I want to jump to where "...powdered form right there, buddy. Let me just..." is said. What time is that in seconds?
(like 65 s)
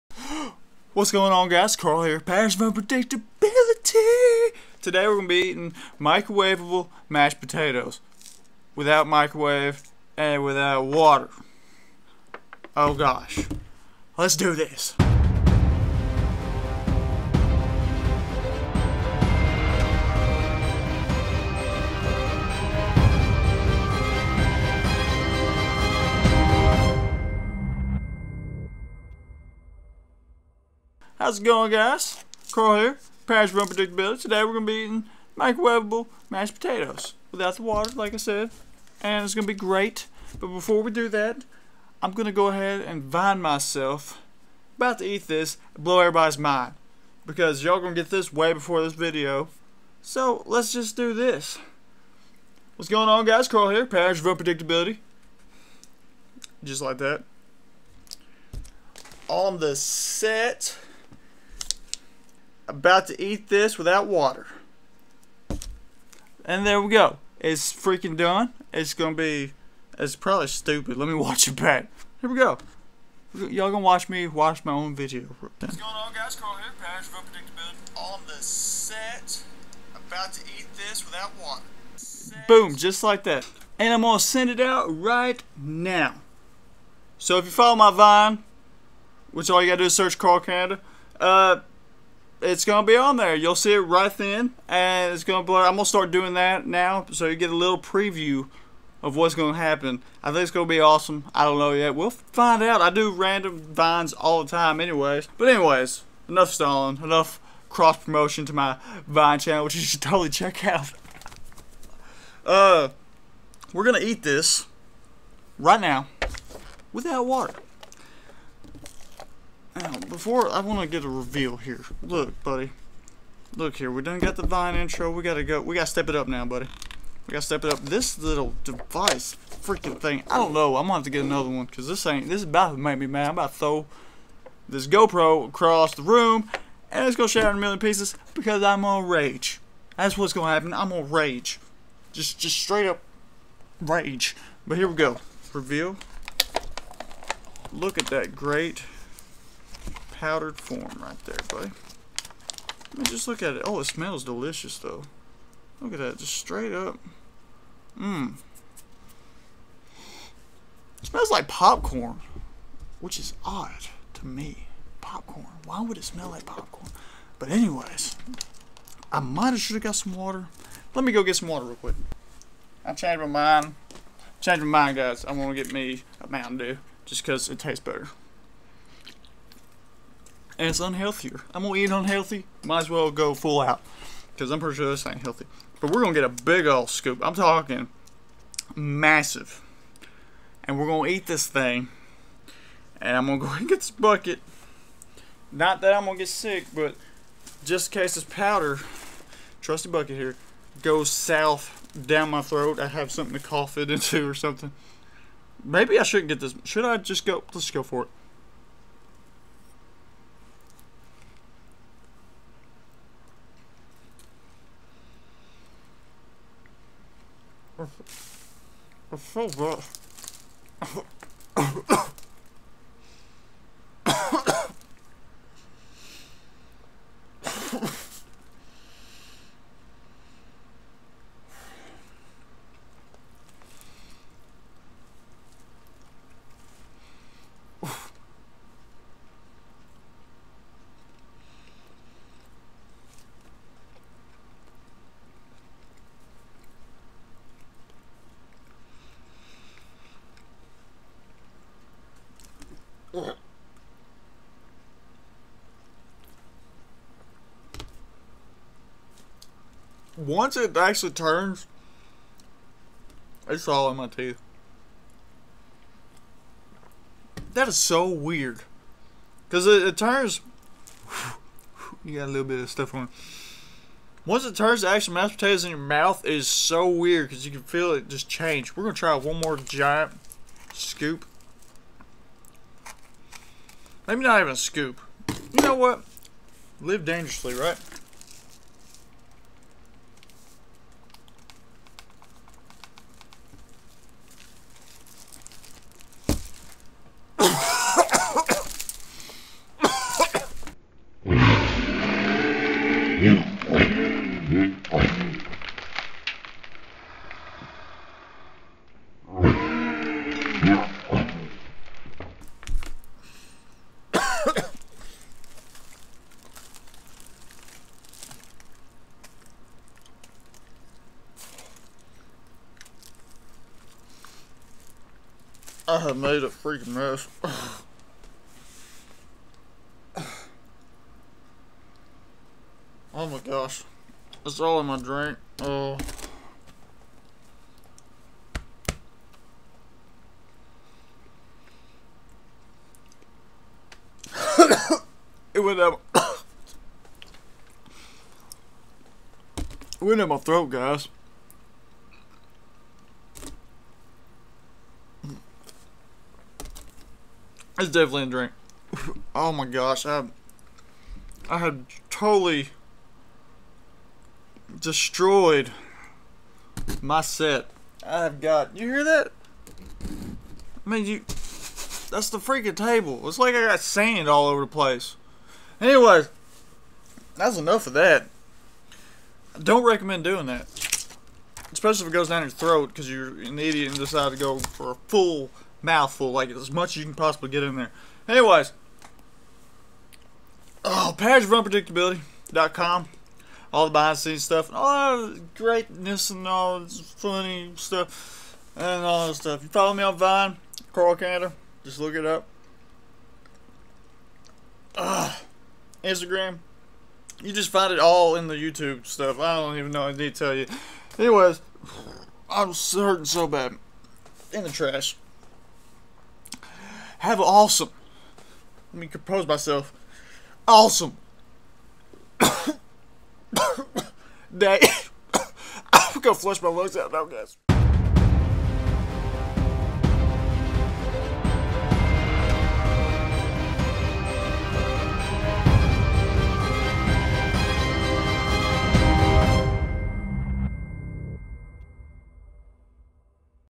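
150 s.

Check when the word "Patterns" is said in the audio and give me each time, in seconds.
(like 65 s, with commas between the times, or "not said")
2 s, 33 s, 53 s.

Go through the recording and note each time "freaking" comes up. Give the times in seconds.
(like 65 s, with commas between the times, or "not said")
67 s, 129 s, 326 s, 372 s.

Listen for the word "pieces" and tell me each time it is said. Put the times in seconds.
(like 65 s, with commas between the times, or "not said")
137 s.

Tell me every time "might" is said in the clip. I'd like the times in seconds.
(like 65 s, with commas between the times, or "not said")
169 s, 182 s.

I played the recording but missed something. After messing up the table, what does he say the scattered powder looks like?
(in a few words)
Sand.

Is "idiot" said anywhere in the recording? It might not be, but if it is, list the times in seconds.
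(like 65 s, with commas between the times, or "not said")
383 s.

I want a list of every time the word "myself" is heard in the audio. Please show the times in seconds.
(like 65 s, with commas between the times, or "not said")
43 s, 419 s.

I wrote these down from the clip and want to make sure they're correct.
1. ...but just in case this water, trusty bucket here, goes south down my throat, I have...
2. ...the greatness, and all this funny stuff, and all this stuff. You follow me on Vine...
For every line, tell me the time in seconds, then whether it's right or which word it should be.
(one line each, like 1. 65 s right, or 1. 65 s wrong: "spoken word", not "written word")
1. 196 s wrong: "powder", not "water"
2. 395 s right.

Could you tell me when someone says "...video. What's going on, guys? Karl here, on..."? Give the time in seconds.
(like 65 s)
74 s.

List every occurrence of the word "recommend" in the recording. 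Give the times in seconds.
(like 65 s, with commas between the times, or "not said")
379 s.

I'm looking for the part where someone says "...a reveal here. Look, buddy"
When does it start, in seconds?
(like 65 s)
121 s.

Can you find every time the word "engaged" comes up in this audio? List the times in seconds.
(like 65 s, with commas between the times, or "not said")
not said.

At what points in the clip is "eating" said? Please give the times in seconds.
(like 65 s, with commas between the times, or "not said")
5 s, 34 s.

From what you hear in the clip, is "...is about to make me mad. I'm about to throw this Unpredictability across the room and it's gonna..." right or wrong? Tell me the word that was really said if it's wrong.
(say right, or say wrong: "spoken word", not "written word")
wrong: "GoPro", not "Unpredictability".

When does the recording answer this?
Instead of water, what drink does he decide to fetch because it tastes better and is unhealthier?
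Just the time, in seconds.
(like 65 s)
176 s.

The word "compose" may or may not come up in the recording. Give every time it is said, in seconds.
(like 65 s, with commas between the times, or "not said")
419 s.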